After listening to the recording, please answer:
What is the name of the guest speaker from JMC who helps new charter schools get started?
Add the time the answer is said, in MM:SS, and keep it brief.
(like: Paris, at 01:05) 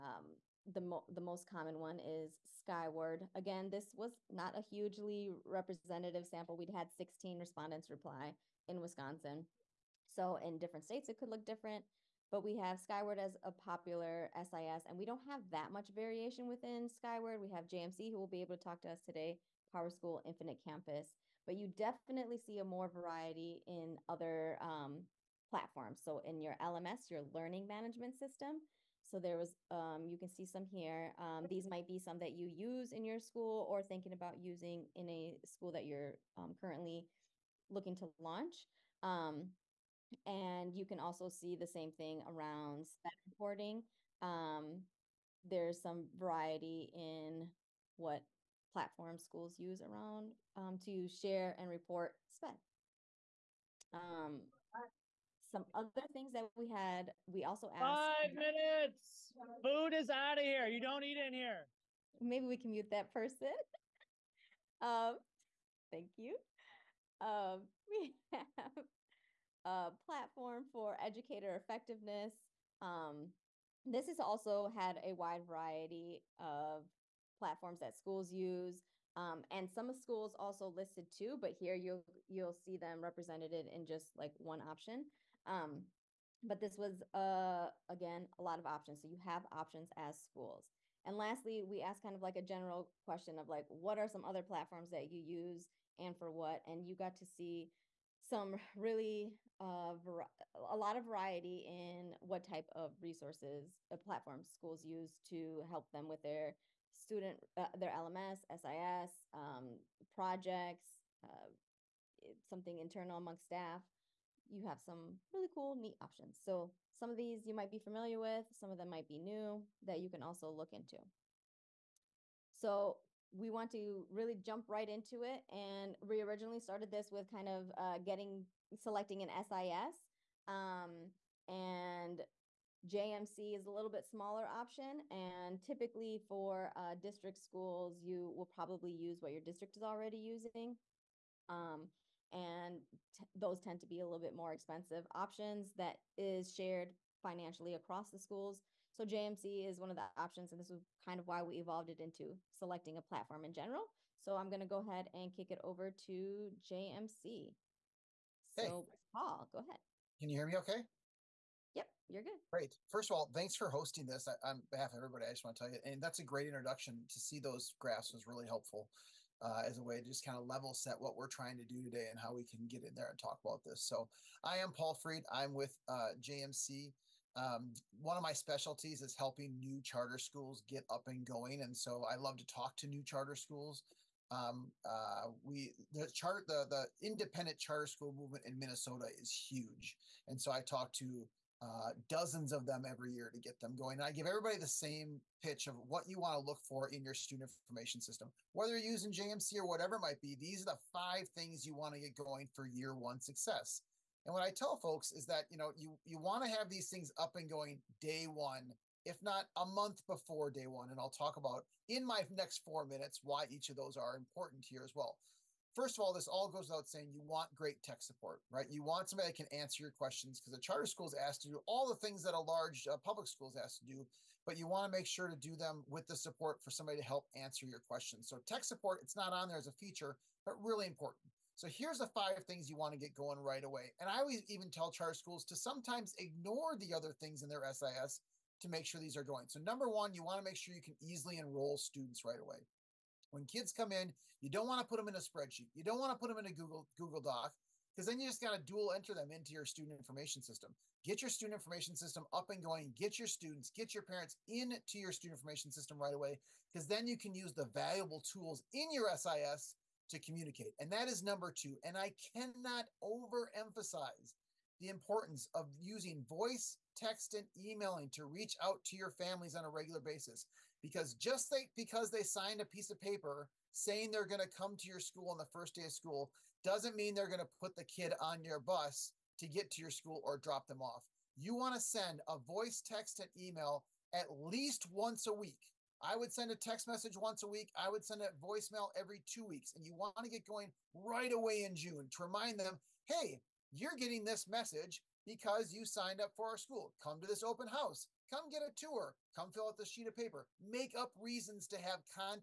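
Paul Freed, at 02:54.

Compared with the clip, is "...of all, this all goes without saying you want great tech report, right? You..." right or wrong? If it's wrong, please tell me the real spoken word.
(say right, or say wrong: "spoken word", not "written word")
wrong: "support", not "report".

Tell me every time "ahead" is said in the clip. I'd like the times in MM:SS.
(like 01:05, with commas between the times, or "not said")
02:34, 02:39.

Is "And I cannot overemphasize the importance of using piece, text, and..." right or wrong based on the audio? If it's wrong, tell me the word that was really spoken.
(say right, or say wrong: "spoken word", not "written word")
wrong: "voice", not "piece".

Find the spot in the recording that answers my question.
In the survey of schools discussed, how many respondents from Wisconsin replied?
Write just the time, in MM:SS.
00:06.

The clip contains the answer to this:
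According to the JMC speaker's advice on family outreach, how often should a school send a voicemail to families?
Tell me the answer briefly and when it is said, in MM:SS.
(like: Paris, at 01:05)
every two weeks, at 04:48.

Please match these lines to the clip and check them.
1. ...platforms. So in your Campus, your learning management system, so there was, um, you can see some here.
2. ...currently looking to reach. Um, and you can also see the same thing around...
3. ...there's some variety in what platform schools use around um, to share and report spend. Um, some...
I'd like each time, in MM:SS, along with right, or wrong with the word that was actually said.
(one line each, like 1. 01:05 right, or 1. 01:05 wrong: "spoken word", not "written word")
1. 00:25 wrong: "LMS", not "Campus"
2. 00:36 wrong: "launch", not "reach"
3. 00:45 right.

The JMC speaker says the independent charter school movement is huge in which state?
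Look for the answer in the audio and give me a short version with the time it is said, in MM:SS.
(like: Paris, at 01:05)
Minnesota, at 03:08.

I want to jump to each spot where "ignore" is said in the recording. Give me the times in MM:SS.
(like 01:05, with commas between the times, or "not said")
03:56.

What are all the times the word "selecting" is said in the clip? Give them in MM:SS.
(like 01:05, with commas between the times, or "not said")
02:08, 02:32.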